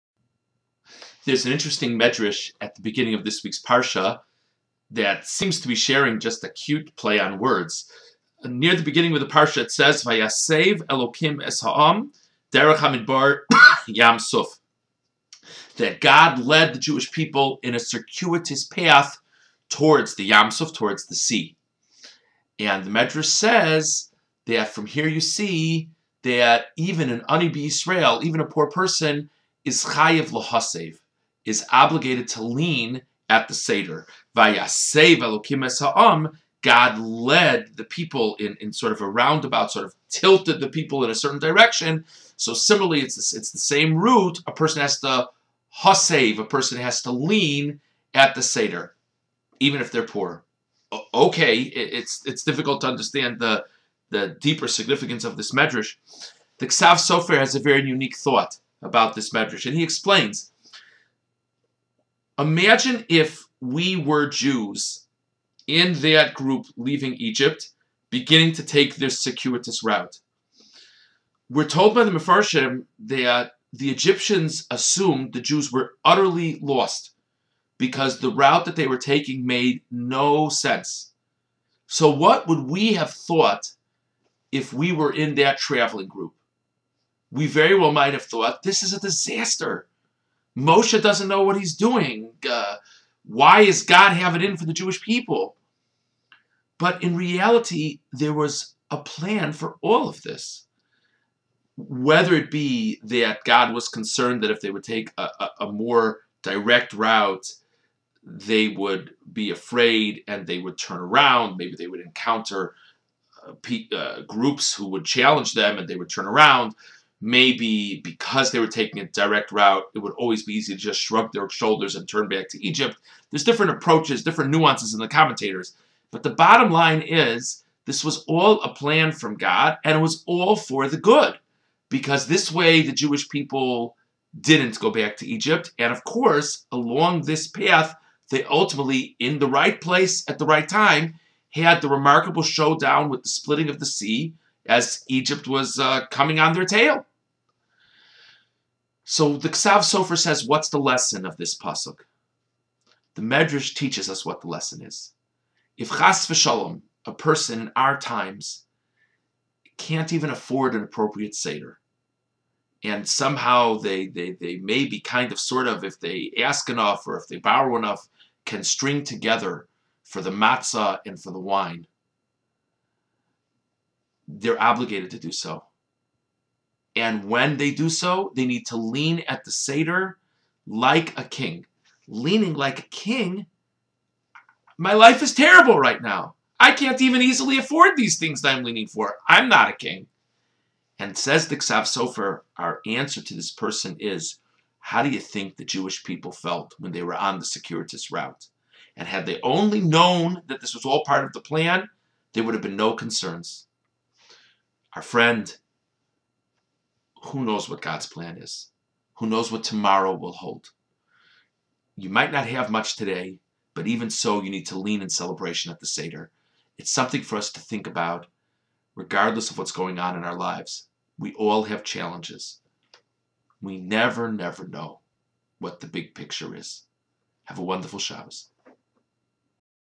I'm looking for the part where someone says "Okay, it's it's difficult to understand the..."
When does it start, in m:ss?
0:51.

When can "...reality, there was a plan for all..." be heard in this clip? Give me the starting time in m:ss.
1:37.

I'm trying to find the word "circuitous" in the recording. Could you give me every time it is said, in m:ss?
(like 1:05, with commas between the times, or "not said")
0:17, 1:09, 3:17.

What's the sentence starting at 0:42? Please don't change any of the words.
So similarly, it's, it's the same root.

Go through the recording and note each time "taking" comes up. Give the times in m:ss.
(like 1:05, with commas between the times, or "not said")
1:18, 1:58.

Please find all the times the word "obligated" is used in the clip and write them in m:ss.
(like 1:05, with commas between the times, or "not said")
0:31, 2:54.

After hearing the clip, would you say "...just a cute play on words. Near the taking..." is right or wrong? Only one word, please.
wrong.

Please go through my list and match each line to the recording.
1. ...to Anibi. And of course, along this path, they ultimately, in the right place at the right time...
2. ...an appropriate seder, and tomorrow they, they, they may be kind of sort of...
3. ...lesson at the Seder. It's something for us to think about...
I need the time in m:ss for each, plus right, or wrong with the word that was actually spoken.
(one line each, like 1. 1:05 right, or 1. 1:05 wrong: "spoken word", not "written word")
1. 2:15 wrong: "Egypt", not "Anibi"
2. 2:40 wrong: "somehow", not "tomorrow"
3. 3:35 wrong: "celebration", not "lesson".